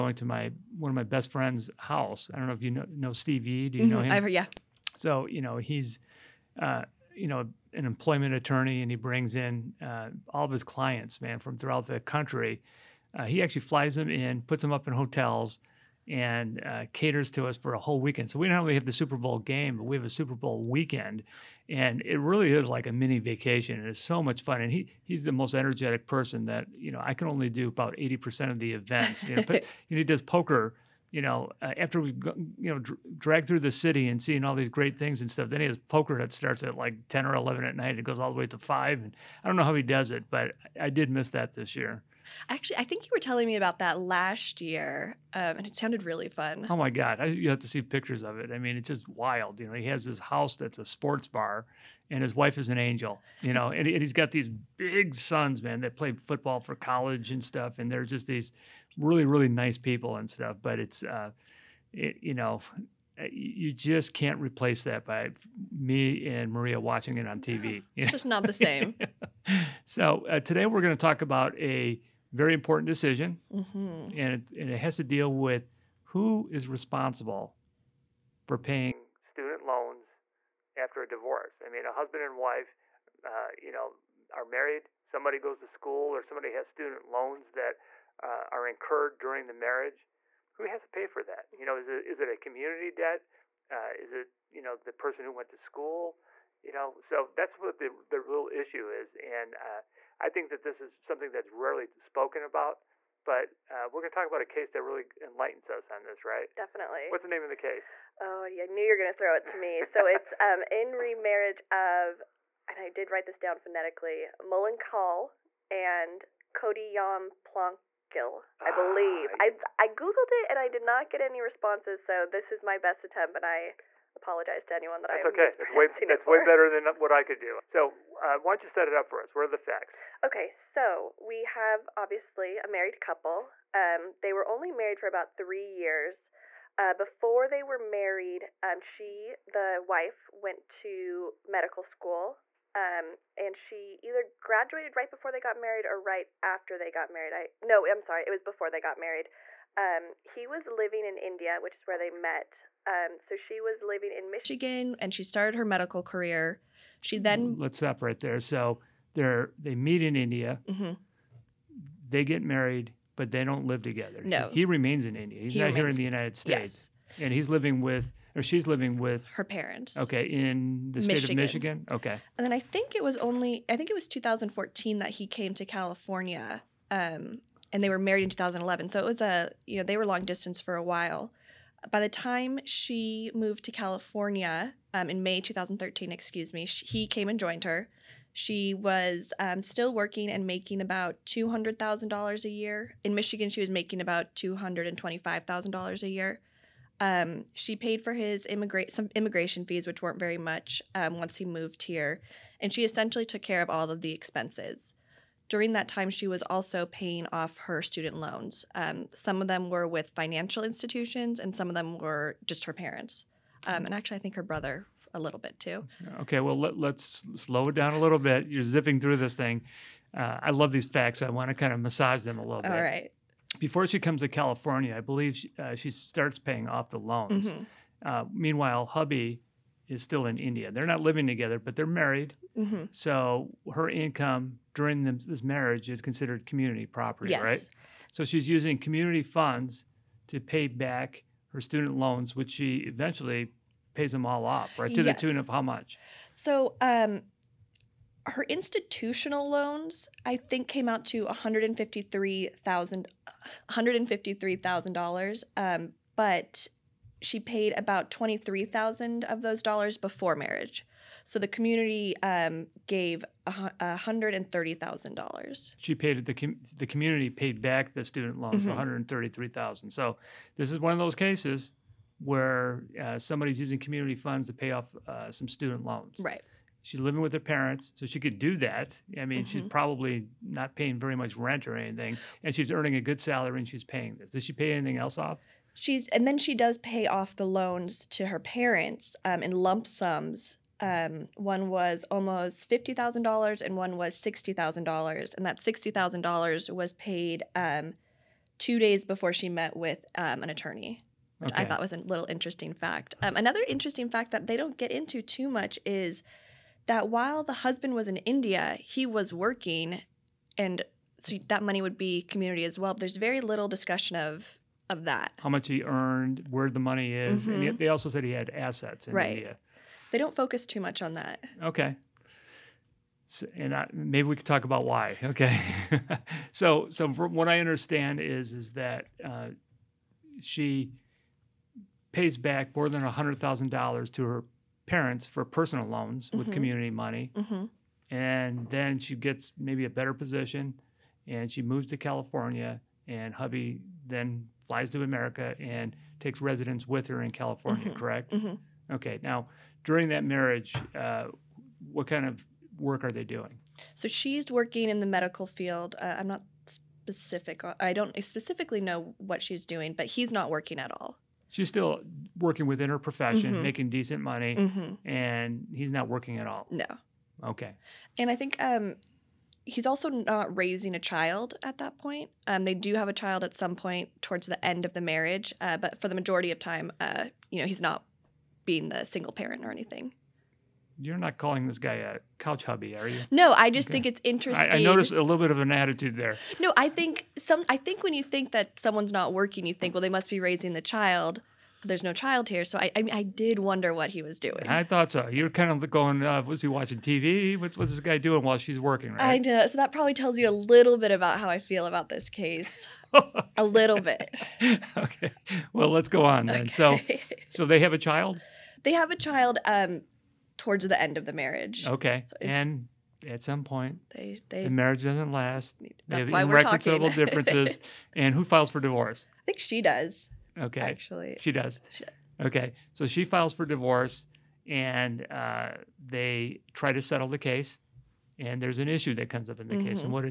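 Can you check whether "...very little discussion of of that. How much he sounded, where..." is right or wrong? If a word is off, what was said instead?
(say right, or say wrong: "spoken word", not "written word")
wrong: "earned", not "sounded".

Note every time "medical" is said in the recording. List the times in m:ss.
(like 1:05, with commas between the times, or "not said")
2:21, 2:35, 5:55.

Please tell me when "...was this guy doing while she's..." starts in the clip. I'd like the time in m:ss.
6:37.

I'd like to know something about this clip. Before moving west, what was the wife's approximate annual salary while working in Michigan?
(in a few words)
$225,000.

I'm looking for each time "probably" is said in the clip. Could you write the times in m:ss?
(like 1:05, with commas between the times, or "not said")
4:39, 6:39.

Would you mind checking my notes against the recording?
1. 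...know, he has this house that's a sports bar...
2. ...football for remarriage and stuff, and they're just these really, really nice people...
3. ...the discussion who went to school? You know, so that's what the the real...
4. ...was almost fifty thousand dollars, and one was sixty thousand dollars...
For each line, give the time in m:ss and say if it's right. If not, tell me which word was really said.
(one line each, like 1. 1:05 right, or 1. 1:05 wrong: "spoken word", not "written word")
1. 0:49 right
2. 0:56 wrong: "college", not "remarriage"
3. 1:34 wrong: "person", not "discussion"
4. 4:51 right.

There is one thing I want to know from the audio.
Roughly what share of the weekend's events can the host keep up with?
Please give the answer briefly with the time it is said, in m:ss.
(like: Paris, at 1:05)
80%, at 0:27.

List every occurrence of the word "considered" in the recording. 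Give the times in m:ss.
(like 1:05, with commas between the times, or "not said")
3:55.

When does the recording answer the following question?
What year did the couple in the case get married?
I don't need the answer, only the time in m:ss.
2:58.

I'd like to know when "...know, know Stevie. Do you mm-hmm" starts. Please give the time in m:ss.
0:02.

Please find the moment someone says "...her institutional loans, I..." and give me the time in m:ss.
4:08.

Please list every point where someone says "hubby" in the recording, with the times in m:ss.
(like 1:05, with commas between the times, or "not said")
3:48, 5:43, 6:22.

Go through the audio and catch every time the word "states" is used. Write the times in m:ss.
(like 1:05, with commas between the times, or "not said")
2:46, 2:51.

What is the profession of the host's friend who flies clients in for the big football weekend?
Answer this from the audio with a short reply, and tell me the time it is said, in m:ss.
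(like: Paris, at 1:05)
Employment attorney, at 0:07.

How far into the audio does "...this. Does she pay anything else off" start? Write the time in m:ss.
4:44.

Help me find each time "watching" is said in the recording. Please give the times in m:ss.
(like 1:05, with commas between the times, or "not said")
1:06, 6:36.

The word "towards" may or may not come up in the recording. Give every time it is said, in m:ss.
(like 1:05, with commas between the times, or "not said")
6:14, 6:50.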